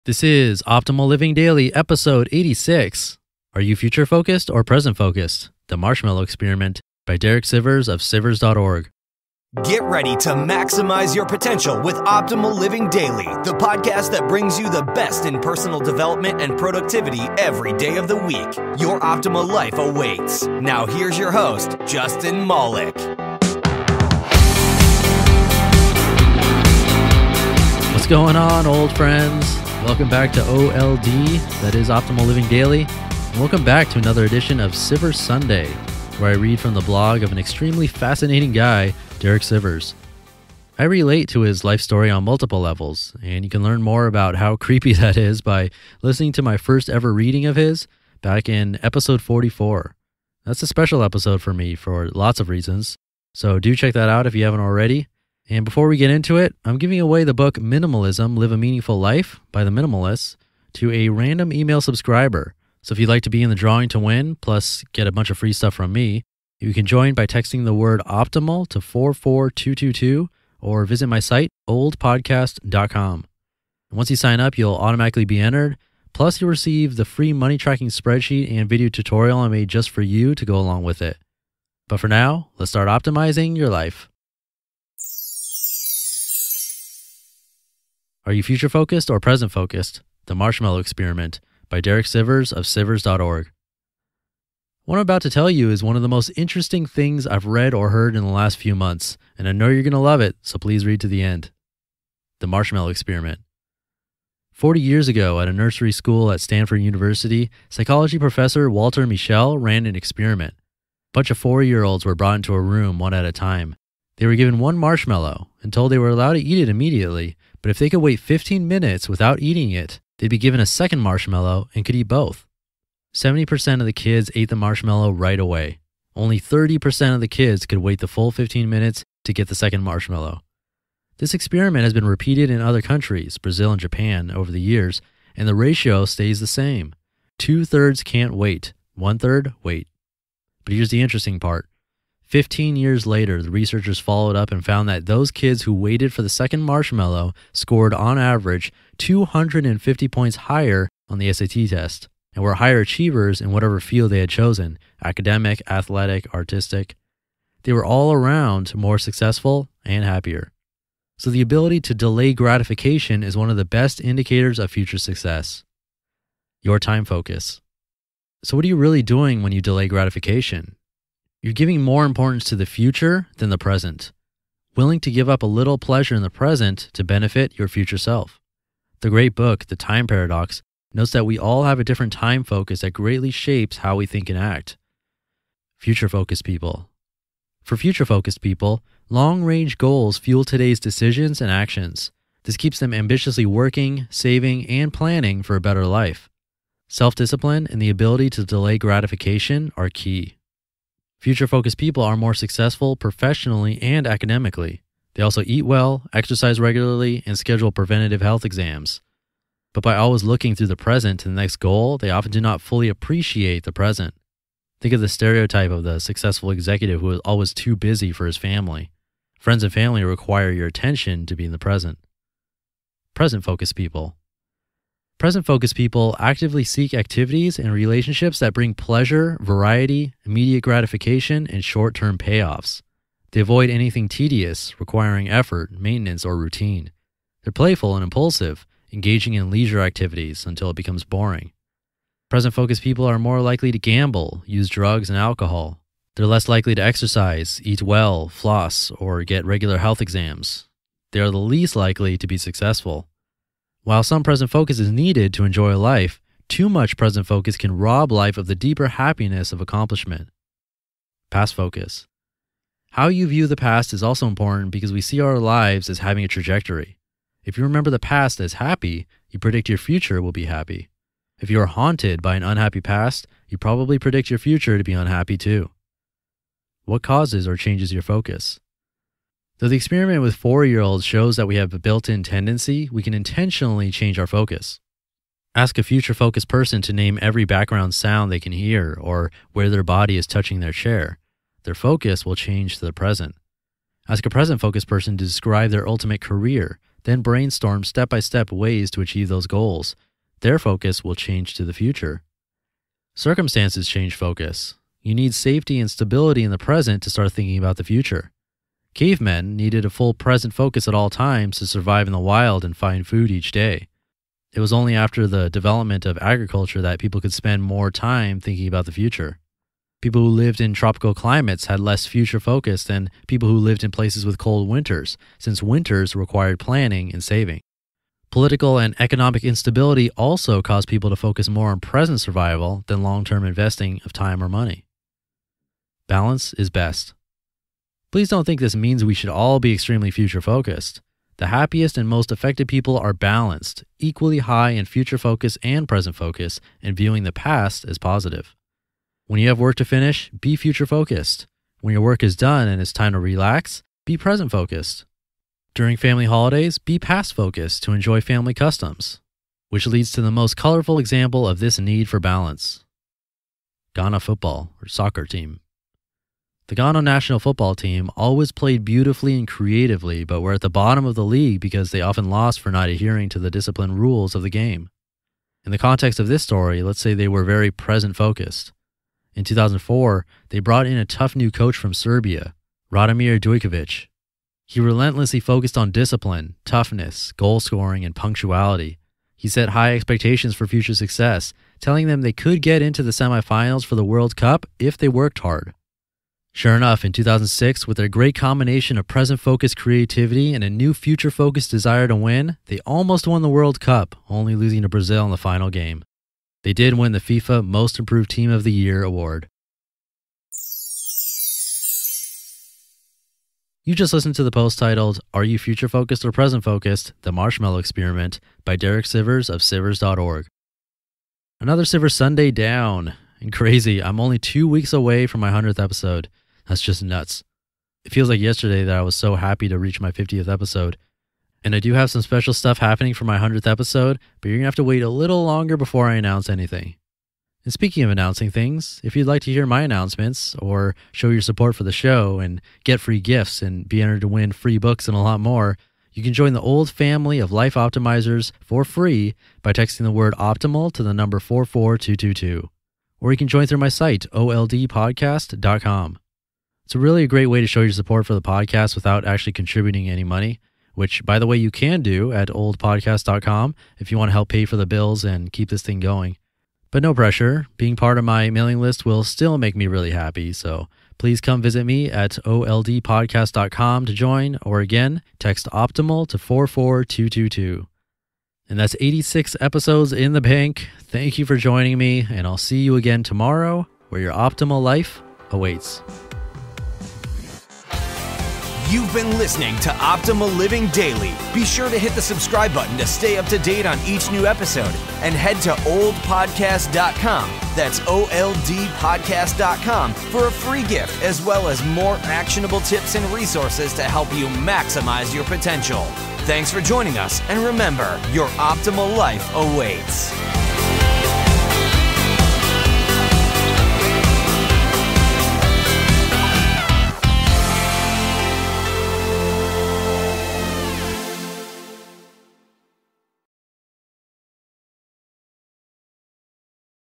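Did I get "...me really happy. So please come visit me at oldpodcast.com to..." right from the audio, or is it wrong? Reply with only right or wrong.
right.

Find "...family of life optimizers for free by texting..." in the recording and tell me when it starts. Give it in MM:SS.
07:26.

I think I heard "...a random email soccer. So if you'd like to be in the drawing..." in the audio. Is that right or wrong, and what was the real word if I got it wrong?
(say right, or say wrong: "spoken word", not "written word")
wrong: "subscriber", not "soccer".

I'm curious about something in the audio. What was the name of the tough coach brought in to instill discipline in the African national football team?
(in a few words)
Radomir Dujkovic.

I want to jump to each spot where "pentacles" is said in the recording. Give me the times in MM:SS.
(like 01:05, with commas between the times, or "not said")
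not said.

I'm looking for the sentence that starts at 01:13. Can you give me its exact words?
And once you sign up, you'll automatically be entered.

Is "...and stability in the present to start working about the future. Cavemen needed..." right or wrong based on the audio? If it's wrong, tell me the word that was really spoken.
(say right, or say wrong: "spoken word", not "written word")
wrong: "thinking", not "working".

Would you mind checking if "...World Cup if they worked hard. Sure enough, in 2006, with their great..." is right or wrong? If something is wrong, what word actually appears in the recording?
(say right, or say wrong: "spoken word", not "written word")
right.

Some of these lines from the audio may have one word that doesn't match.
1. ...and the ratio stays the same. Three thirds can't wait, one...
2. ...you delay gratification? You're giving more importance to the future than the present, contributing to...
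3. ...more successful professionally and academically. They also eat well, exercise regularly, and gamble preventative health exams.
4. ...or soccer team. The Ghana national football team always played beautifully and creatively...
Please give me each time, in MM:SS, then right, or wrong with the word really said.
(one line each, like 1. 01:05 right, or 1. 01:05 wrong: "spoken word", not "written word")
1. 02:15 wrong: "Two", not "Three"
2. 02:49 wrong: "willing", not "contributing"
3. 03:22 wrong: "schedule", not "gamble"
4. 06:04 right.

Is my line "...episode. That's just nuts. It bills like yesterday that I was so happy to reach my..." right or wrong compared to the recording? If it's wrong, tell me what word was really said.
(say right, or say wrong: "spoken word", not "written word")
wrong: "feels", not "bills".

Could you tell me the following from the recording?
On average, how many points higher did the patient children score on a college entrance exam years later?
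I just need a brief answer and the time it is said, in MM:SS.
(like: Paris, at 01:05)
250, at 02:28.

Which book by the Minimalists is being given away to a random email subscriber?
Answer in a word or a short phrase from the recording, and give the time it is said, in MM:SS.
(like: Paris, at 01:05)
Minimalism Live a Meaningful Life, at 00:57.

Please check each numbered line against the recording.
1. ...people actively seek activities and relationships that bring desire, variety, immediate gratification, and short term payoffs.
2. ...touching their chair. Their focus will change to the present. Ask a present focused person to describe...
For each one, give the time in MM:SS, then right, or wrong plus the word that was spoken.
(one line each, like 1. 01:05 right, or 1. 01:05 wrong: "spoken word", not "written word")
1. 03:45 wrong: "pleasure", not "desire"
2. 04:50 right.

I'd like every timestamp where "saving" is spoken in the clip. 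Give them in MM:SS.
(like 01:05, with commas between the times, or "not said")
03:14, 05:27.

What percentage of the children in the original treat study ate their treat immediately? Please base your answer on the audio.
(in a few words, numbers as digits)
70%.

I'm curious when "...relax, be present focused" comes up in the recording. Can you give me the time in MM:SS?
05:53.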